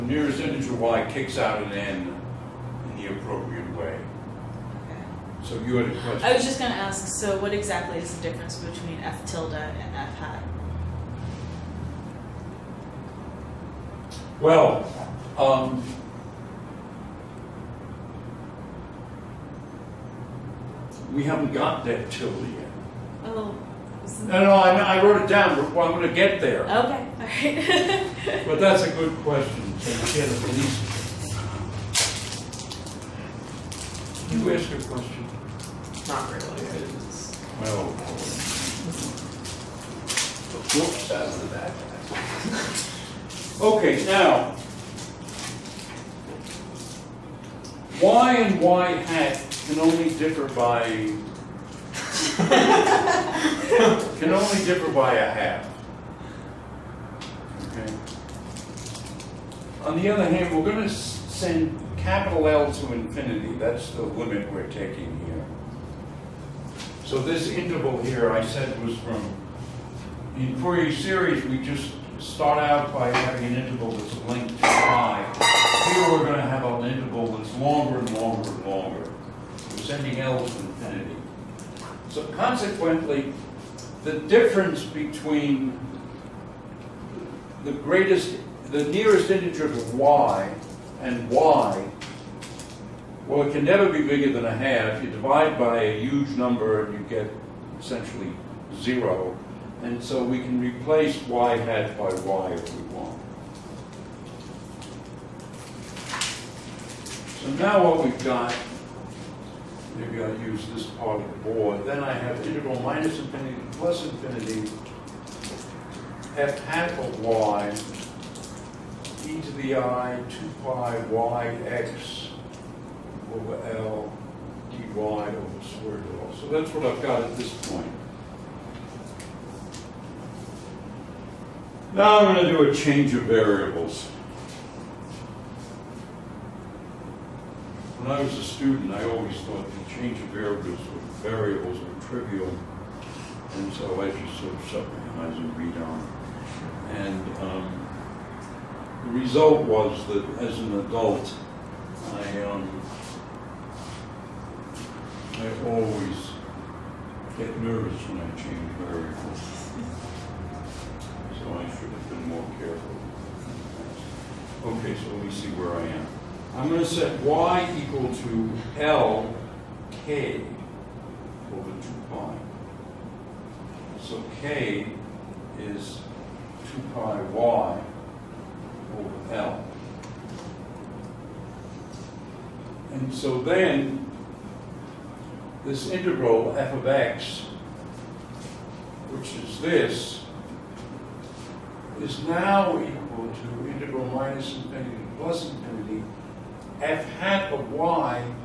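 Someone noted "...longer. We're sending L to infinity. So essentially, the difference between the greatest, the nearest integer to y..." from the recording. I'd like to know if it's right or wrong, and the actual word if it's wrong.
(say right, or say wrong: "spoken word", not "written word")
wrong: "consequently", not "essentially".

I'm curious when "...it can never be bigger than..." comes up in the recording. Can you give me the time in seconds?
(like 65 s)
93 s.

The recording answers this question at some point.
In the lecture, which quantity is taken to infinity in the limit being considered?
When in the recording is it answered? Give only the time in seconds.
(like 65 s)
61 s.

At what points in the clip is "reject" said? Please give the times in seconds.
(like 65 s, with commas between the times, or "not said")
not said.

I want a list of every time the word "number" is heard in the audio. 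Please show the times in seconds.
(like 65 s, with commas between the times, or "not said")
96 s.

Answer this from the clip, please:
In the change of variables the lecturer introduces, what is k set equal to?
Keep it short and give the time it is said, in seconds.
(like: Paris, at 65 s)
2 pi y over L, at 176 s.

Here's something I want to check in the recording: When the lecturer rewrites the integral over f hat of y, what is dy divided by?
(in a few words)
square root of L.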